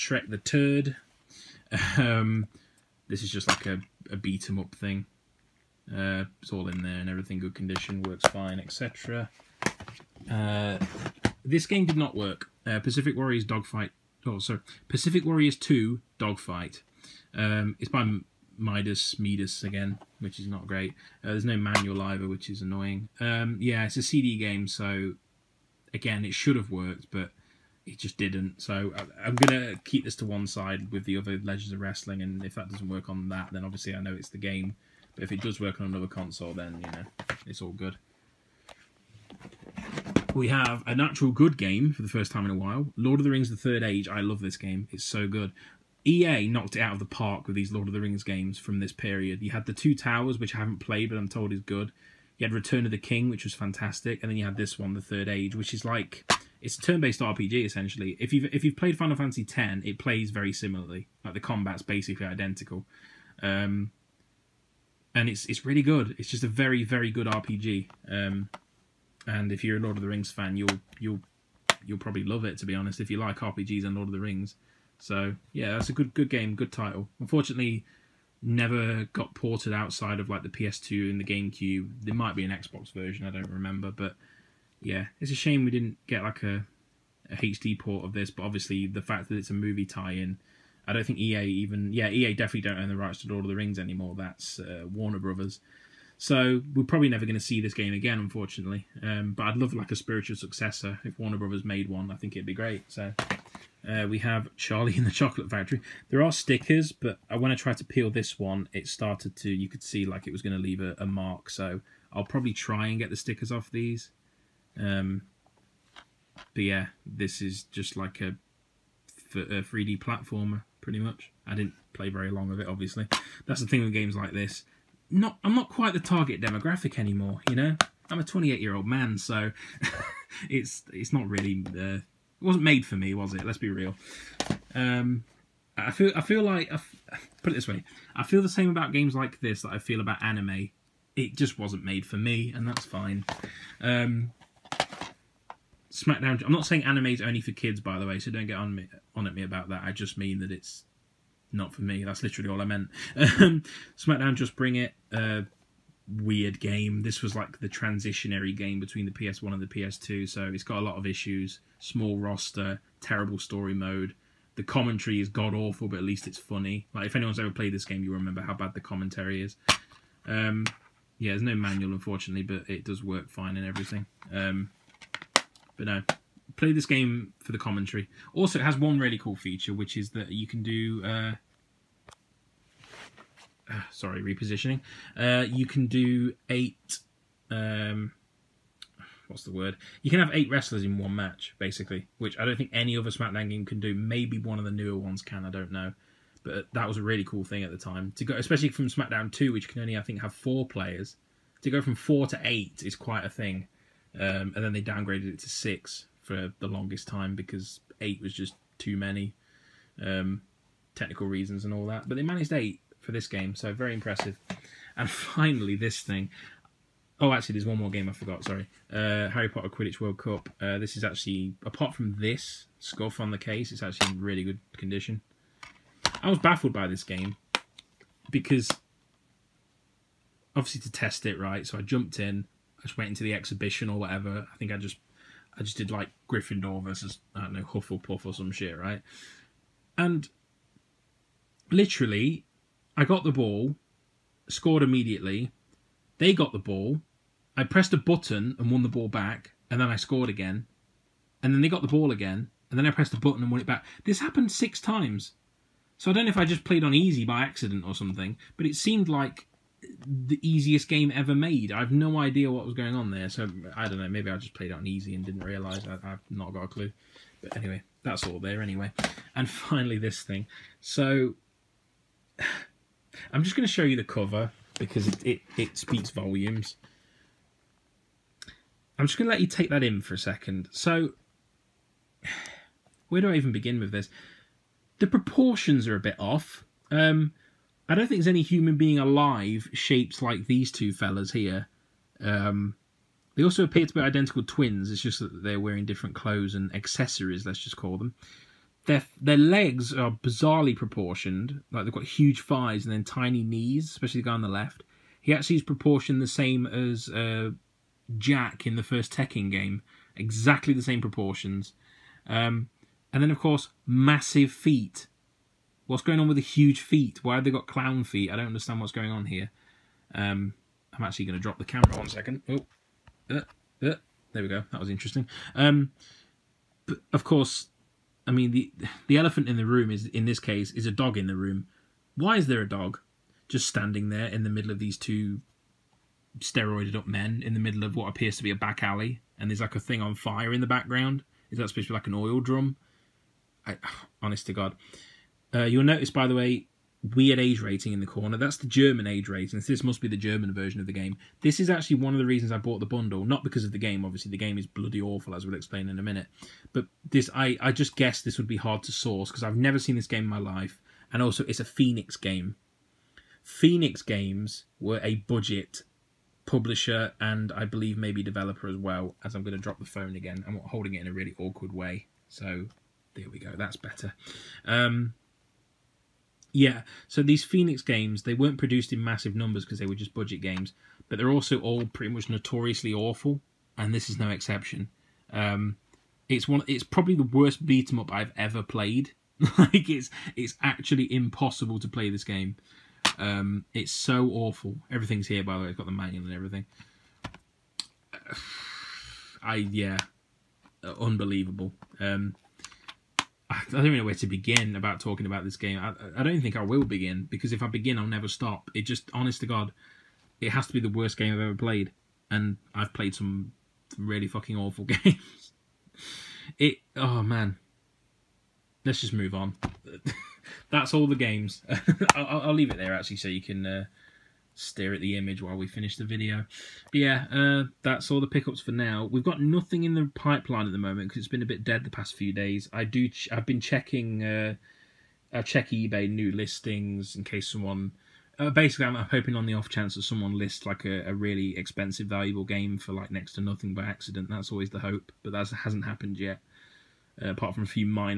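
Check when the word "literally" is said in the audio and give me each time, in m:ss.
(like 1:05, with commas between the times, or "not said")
2:32, 4:01.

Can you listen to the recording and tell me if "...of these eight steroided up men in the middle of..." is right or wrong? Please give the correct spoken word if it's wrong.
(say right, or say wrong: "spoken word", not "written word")
wrong: "two", not "eight".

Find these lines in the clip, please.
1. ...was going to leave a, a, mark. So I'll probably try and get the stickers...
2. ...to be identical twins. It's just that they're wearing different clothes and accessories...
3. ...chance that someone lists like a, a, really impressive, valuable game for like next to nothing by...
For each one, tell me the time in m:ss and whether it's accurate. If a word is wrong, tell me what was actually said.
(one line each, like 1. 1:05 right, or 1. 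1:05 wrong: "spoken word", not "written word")
1. 1:50 right
2. 4:53 right
3. 7:19 wrong: "expensive", not "impressive".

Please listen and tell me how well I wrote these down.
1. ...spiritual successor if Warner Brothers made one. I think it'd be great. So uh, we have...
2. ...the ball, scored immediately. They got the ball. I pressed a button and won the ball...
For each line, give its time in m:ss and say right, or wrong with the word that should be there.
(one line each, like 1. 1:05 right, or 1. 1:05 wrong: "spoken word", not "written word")
1. 1:39 right
2. 4:03 right.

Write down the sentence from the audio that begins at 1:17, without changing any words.
Unfortunately, never got ported outside of like the PS2 and the GameCube.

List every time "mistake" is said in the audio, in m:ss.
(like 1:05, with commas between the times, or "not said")
not said.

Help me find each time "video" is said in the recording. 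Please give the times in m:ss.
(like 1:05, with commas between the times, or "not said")
7:06.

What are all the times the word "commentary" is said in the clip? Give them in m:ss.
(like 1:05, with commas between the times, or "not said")
2:44, 2:48, 2:57.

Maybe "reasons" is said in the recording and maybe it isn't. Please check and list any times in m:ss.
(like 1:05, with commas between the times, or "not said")
3:31, 5:52.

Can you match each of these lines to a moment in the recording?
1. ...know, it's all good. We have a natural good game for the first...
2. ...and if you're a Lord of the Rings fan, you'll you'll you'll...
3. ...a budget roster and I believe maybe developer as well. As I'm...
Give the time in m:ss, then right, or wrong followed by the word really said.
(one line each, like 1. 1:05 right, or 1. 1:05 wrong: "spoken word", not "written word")
1. 0:36 right
2. 1:09 right
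3. 6:05 wrong: "publisher", not "roster".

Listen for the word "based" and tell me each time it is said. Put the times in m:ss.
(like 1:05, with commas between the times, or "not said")
0:56.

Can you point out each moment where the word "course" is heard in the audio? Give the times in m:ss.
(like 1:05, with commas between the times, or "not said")
5:13, 5:27.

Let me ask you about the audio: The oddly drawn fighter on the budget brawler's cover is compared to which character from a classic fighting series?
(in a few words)
Jack.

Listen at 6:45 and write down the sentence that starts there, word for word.
I, I don't think I will begin because if I begin, I'll never stop.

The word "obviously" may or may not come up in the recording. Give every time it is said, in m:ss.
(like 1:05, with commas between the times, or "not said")
0:33, 1:28, 2:02, 3:50, 5:54.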